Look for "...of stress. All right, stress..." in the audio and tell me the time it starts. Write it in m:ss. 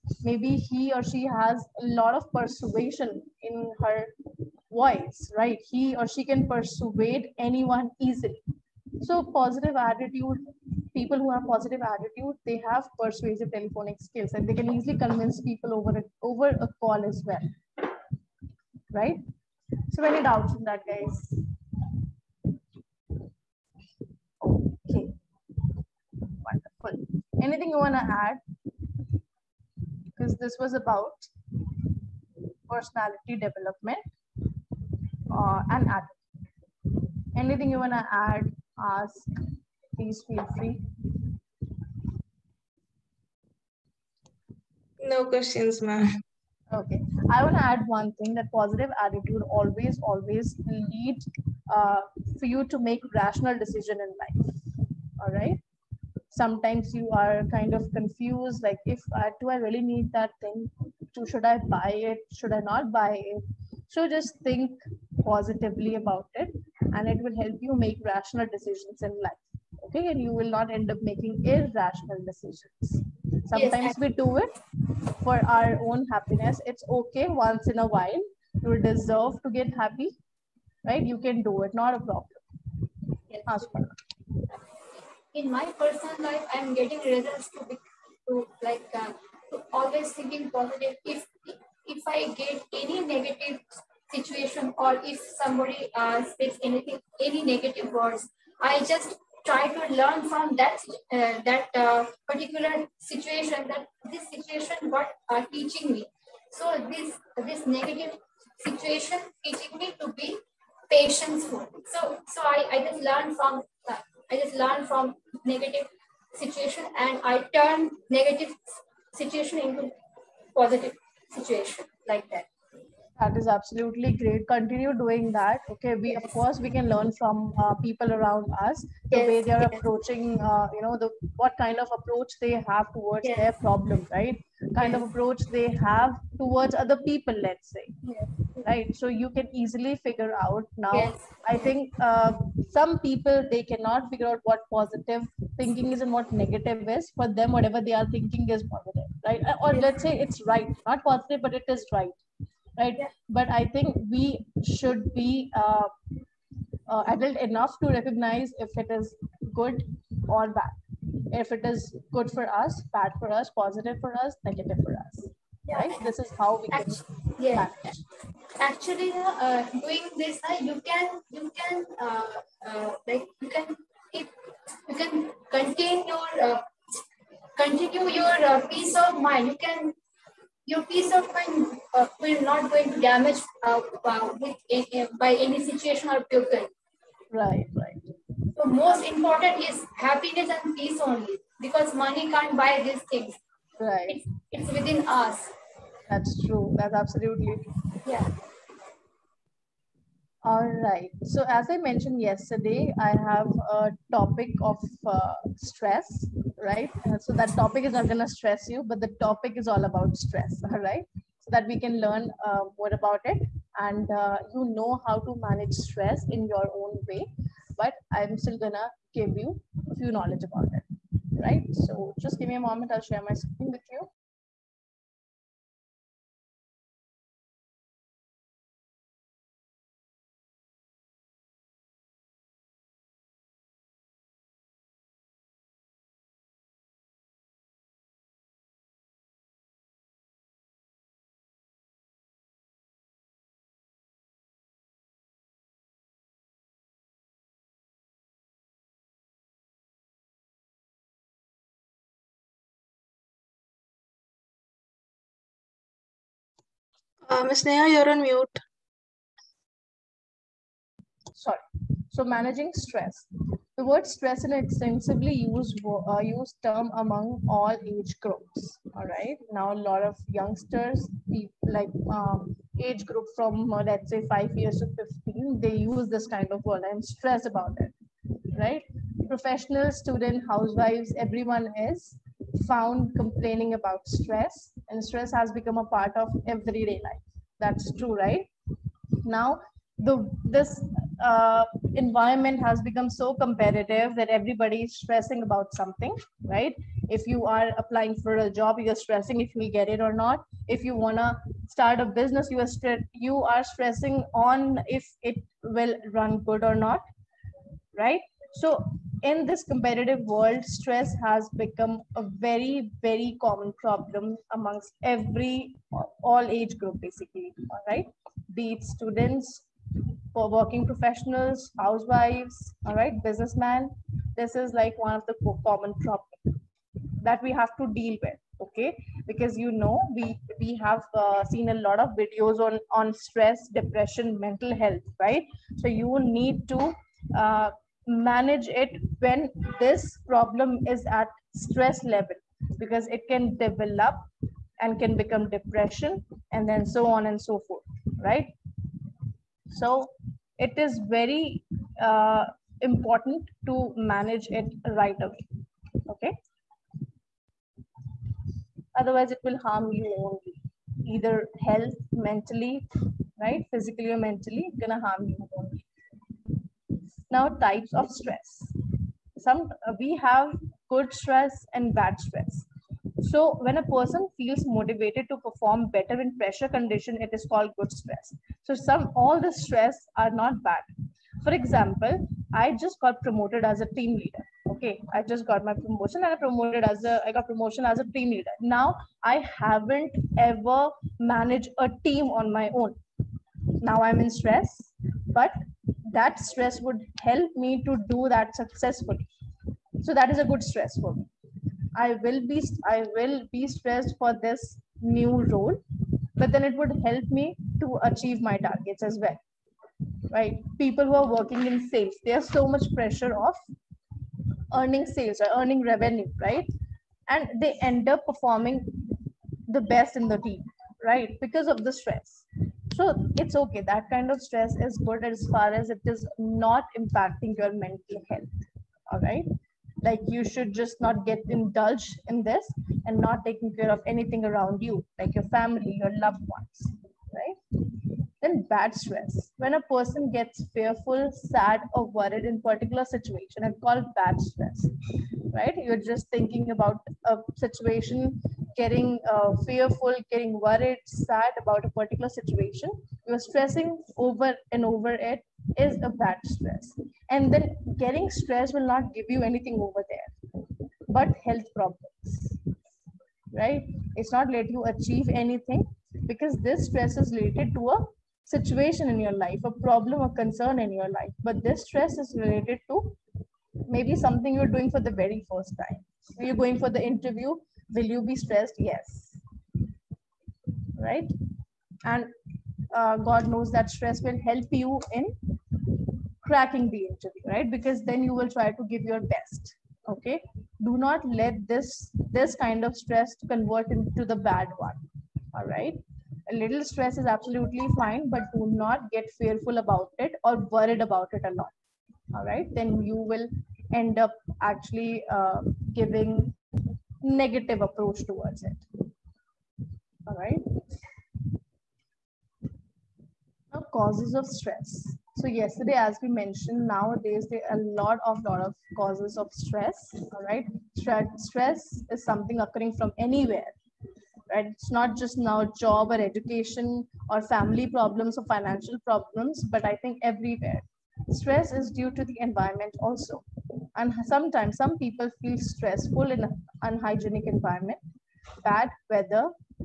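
8:39.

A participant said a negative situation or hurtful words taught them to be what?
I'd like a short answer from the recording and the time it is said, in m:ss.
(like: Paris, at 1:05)
patient, at 1:50.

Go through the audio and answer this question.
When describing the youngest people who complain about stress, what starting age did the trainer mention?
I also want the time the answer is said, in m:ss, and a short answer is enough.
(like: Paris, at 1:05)
5, at 4:34.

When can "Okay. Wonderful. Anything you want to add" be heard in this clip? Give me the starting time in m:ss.
0:24.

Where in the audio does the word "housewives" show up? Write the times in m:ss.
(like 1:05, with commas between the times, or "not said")
4:40, 5:21.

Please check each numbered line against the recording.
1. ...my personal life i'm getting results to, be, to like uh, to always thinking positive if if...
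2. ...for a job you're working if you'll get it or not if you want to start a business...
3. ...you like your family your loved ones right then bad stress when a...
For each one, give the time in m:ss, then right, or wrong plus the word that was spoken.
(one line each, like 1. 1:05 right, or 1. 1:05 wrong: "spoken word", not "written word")
1. 1:25 right
2. 4:58 wrong: "stressing", not "working"
3. 7:14 right.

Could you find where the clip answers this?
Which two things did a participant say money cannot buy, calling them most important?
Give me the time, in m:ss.
3:10.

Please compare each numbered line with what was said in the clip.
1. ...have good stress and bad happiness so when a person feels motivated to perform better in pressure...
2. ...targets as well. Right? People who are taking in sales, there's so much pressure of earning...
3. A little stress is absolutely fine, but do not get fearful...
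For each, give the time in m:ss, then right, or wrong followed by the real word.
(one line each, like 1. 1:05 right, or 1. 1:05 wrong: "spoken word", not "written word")
1. 6:10 wrong: "stress", not "happiness"
2. 6:48 wrong: "working", not "taking"
3. 8:16 right.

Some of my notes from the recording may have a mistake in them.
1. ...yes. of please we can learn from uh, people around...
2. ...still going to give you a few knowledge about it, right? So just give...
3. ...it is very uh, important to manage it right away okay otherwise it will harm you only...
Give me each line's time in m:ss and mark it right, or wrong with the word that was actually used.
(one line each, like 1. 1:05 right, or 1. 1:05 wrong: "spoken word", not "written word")
1. 2:06 wrong: "course", not "please"
2. 3:38 right
3. 5:50 right.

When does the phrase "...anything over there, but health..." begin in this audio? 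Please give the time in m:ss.
7:39.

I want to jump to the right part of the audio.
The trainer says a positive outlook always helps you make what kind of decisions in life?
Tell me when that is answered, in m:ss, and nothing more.
0:53.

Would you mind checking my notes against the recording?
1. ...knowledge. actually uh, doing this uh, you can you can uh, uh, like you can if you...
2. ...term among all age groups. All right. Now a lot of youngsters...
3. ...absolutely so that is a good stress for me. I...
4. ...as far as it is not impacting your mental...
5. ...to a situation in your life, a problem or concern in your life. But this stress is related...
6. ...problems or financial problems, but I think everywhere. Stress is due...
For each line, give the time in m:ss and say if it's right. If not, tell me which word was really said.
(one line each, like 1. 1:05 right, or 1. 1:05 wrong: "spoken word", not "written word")
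1. 2:47 wrong: "manage", not "knowledge"
2. 4:26 right
3. 6:38 wrong: "successfully", not "absolutely"
4. 7:05 right
5. 7:47 right
6. 8:47 right.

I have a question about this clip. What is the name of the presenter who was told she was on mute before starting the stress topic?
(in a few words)
Neha.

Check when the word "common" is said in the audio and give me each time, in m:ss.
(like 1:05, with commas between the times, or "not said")
5:13, 5:25.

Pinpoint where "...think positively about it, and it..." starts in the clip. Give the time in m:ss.
1:04.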